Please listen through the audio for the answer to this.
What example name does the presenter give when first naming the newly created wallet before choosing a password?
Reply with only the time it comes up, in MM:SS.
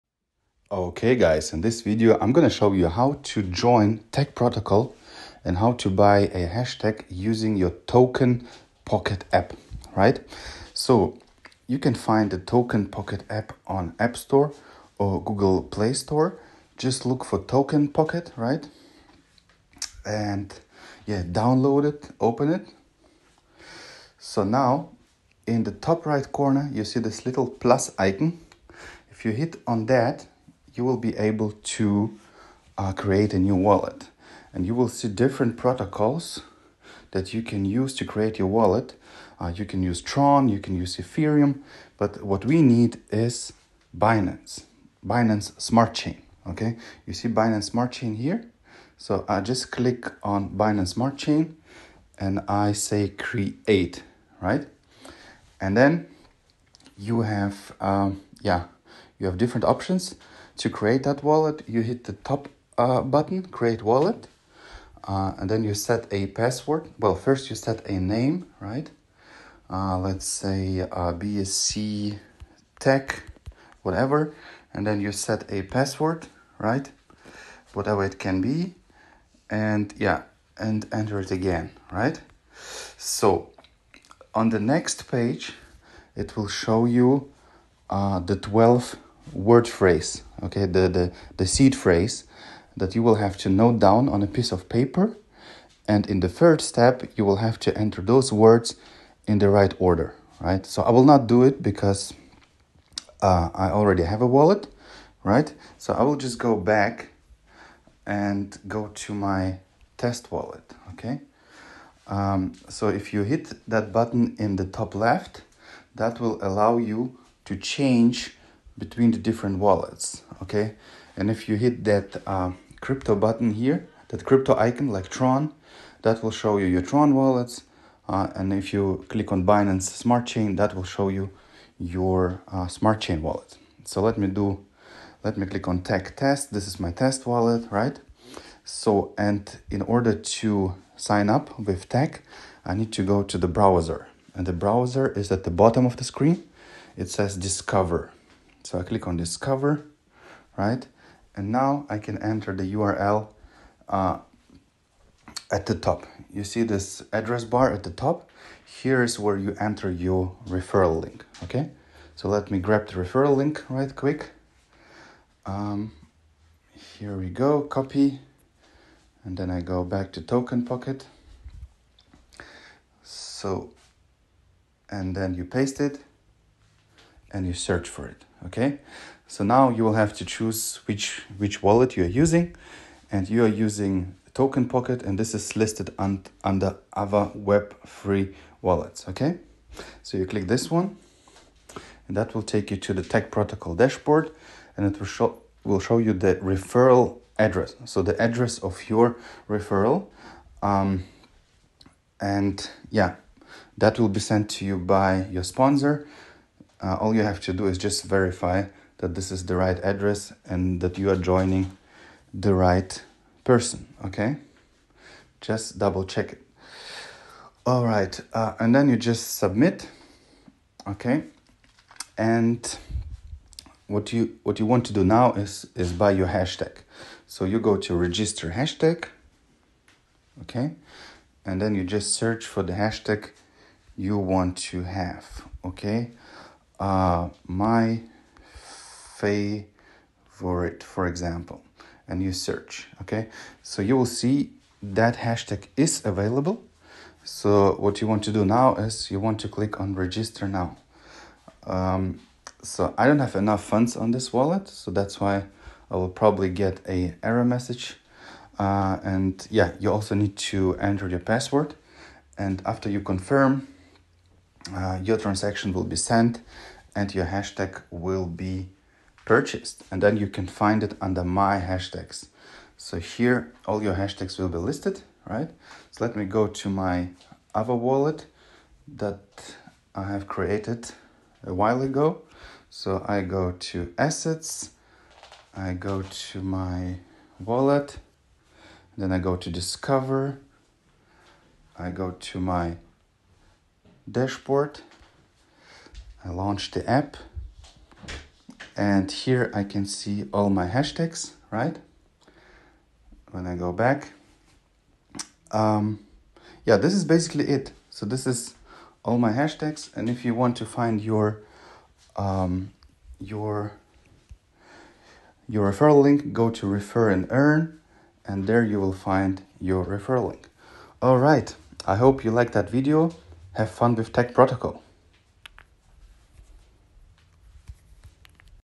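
01:11.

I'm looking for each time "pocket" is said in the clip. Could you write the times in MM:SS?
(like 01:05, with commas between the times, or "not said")
00:08, 00:12, 00:17, 02:50, 03:04.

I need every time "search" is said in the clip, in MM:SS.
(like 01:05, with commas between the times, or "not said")
02:57, 03:52, 04:02.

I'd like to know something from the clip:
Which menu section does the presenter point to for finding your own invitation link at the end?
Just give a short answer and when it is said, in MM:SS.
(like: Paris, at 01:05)
Refer and earn, at 05:16.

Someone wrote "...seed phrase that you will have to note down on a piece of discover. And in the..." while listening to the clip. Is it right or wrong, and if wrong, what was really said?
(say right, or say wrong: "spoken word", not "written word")
wrong: "paper", not "discover".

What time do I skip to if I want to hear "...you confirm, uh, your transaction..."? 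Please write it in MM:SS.
04:22.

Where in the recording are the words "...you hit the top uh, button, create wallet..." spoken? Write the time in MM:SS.
01:01.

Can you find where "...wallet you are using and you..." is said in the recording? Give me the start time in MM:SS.
03:01.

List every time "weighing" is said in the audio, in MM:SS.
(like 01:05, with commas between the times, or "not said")
not said.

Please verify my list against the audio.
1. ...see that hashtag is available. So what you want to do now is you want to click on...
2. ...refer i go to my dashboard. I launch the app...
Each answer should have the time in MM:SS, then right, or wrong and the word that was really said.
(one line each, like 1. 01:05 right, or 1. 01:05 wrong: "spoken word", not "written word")
1. 04:04 right
2. 04:49 wrong: "discover", not "refer".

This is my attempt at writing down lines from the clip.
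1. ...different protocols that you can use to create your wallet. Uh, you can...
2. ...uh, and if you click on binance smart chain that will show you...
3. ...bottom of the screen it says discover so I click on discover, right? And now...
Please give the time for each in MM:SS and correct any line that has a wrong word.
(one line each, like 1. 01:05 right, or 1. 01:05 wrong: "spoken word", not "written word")
1. 00:35 right
2. 02:08 right
3. 02:25 right.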